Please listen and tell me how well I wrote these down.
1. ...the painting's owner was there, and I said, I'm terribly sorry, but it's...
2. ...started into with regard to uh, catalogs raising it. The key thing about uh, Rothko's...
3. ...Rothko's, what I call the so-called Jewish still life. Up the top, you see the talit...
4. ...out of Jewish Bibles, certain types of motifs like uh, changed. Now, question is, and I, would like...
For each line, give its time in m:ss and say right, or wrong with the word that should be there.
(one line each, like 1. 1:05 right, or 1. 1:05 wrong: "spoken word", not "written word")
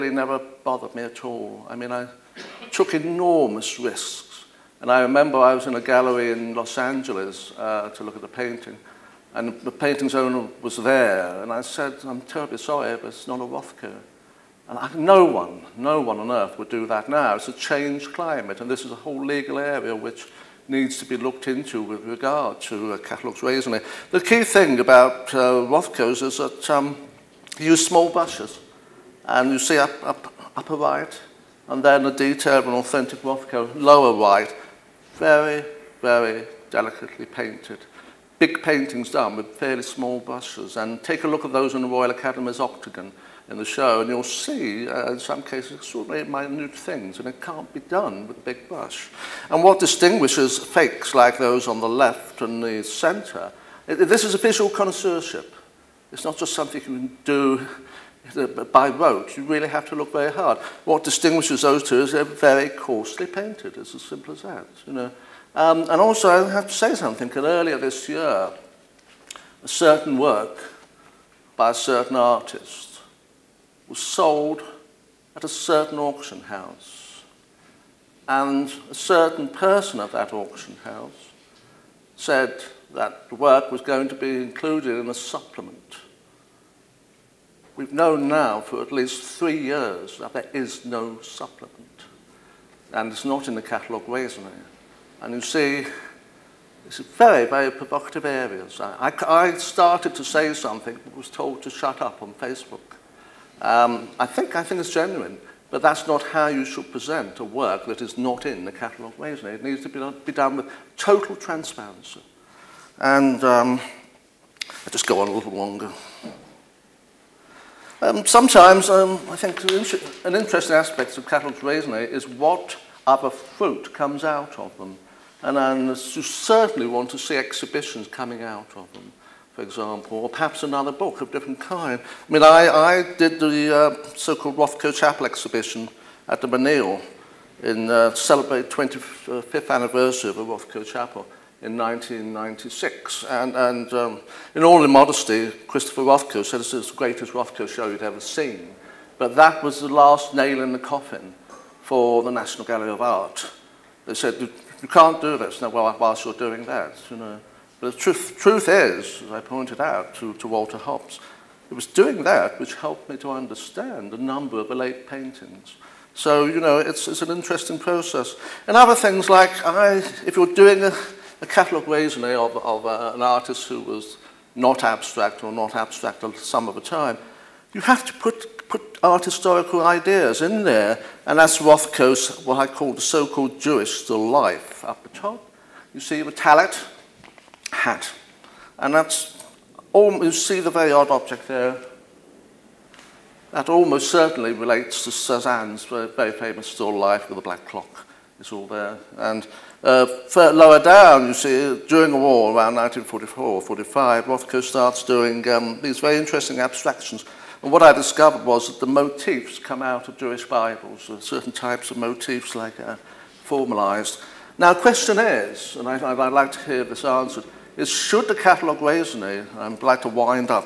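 1. 0:09 right
2. 0:21 wrong: "looked", not "started"
3. 3:01 right
4. 3:29 wrong: "formalized", not "changed".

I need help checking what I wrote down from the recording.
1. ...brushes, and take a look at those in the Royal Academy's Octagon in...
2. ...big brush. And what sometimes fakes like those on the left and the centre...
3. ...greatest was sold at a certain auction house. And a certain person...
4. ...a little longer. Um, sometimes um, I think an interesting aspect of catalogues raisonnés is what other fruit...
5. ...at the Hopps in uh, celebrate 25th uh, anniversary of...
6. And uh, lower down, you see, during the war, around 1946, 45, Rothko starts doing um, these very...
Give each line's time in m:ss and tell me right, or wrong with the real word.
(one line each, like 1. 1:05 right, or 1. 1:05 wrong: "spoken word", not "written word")
1. 0:40 right
2. 0:48 wrong: "distinguishes", not "sometimes"
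3. 1:12 wrong: "artist", not "greatest"
4. 1:55 right
5. 2:16 wrong: "Menil", not "Hopps"
6. 3:19 wrong: "1944", not "1946".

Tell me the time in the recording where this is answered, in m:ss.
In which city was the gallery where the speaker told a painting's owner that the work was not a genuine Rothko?
0:06.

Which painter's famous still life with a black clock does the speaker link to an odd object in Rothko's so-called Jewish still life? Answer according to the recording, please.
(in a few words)
Cezanne.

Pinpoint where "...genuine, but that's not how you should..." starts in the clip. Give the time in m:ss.
1:44.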